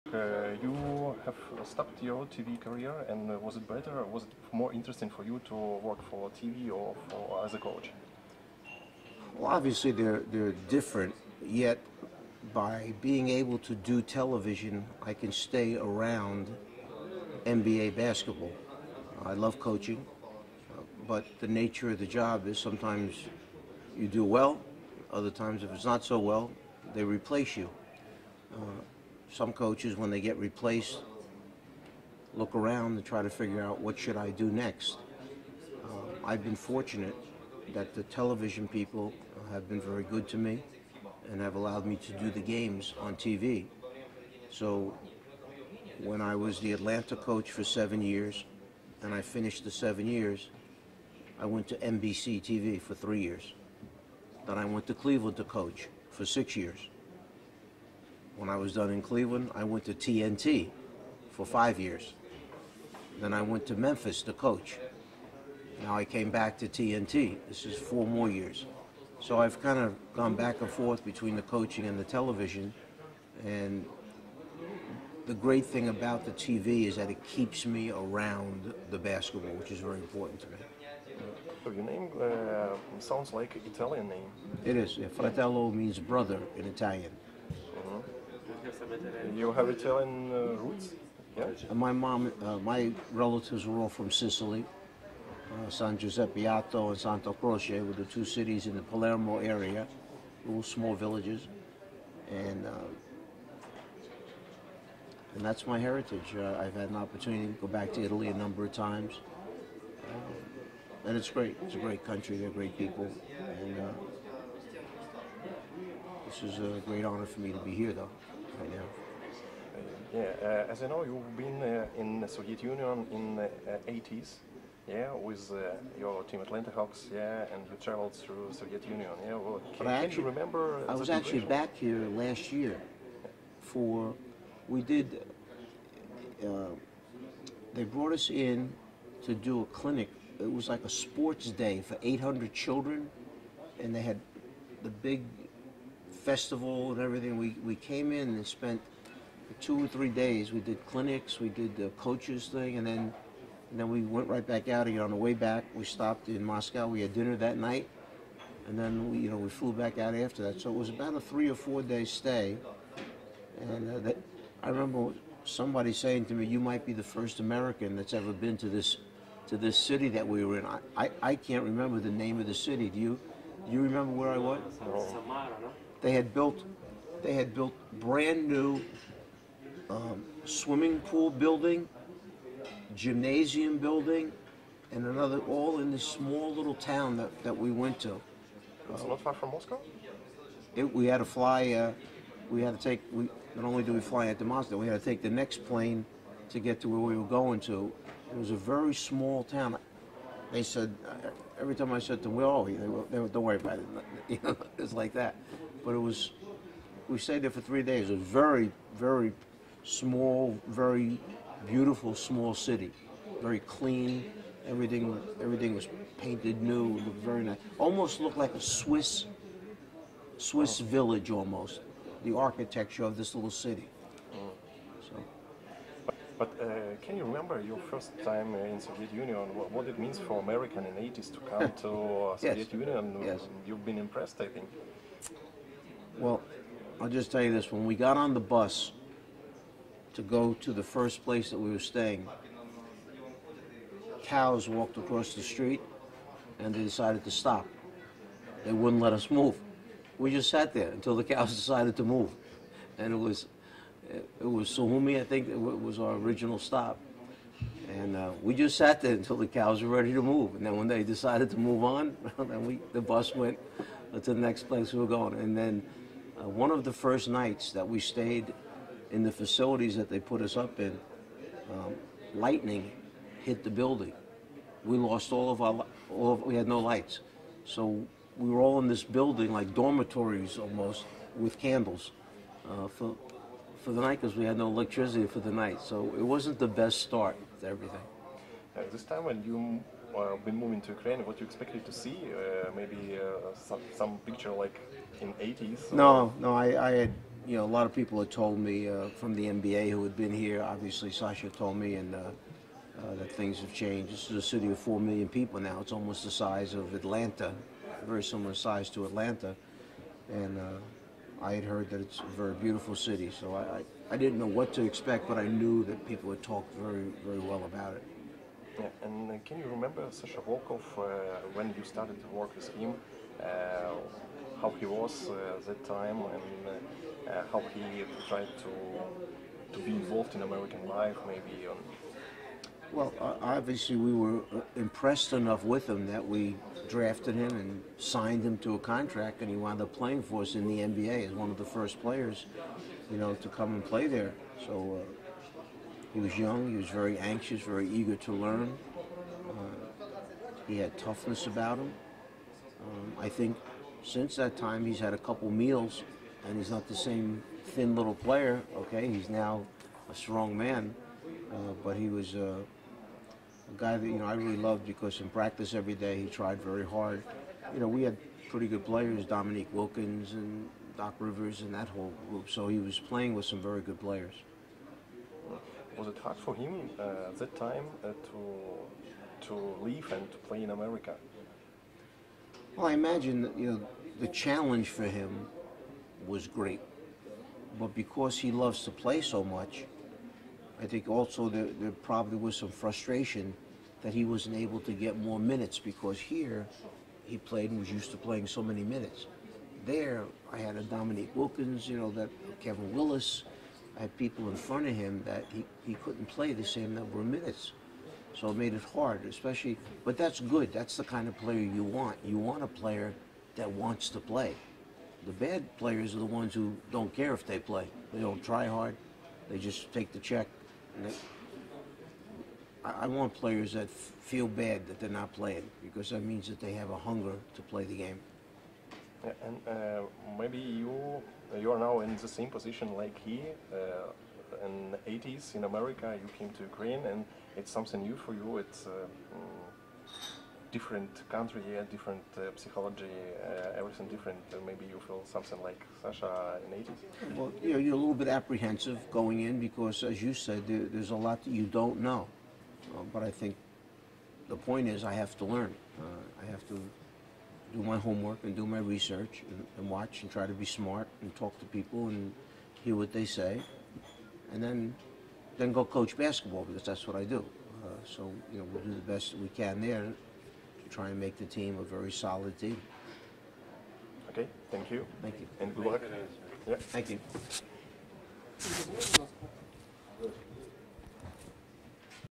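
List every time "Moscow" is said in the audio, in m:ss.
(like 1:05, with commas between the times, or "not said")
2:36, 3:09, 3:14.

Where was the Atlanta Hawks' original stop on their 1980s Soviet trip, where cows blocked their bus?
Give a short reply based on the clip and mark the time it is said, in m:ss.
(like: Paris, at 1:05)
Sukhumi, at 4:14.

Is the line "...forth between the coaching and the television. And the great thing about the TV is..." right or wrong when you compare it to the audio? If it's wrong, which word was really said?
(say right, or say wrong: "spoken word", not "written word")
right.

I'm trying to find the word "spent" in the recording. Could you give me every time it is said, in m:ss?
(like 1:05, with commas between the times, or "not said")
2:28.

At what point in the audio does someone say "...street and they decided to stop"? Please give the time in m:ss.
4:05.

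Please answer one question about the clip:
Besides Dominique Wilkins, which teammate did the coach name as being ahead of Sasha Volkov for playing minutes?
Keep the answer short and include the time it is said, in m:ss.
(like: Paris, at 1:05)
Kevin Willis, at 6:42.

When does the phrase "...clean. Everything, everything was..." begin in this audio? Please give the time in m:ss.
3:33.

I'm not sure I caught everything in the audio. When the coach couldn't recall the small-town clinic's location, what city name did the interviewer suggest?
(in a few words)
Samara.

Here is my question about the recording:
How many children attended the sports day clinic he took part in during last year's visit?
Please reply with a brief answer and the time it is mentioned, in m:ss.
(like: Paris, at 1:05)
800, at 2:22.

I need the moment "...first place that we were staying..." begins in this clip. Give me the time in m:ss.
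4:00.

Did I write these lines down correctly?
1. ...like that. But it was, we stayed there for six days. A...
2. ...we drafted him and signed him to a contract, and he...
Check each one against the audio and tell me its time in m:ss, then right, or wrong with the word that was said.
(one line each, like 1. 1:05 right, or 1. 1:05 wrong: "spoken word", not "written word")
1. 3:24 wrong: "three", not "six"
2. 5:36 right.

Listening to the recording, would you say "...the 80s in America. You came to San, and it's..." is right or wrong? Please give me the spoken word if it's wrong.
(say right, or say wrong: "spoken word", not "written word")
wrong: "Ukraine", not "San".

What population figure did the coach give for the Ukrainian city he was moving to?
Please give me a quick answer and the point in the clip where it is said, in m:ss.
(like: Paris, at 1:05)
4 million, at 5:04.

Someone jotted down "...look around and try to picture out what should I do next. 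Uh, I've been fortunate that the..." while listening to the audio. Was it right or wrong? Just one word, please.
wrong.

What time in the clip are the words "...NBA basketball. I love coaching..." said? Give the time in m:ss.
0:17.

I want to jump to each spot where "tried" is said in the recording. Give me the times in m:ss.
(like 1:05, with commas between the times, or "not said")
5:28, 6:06.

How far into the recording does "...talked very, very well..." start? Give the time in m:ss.
5:16.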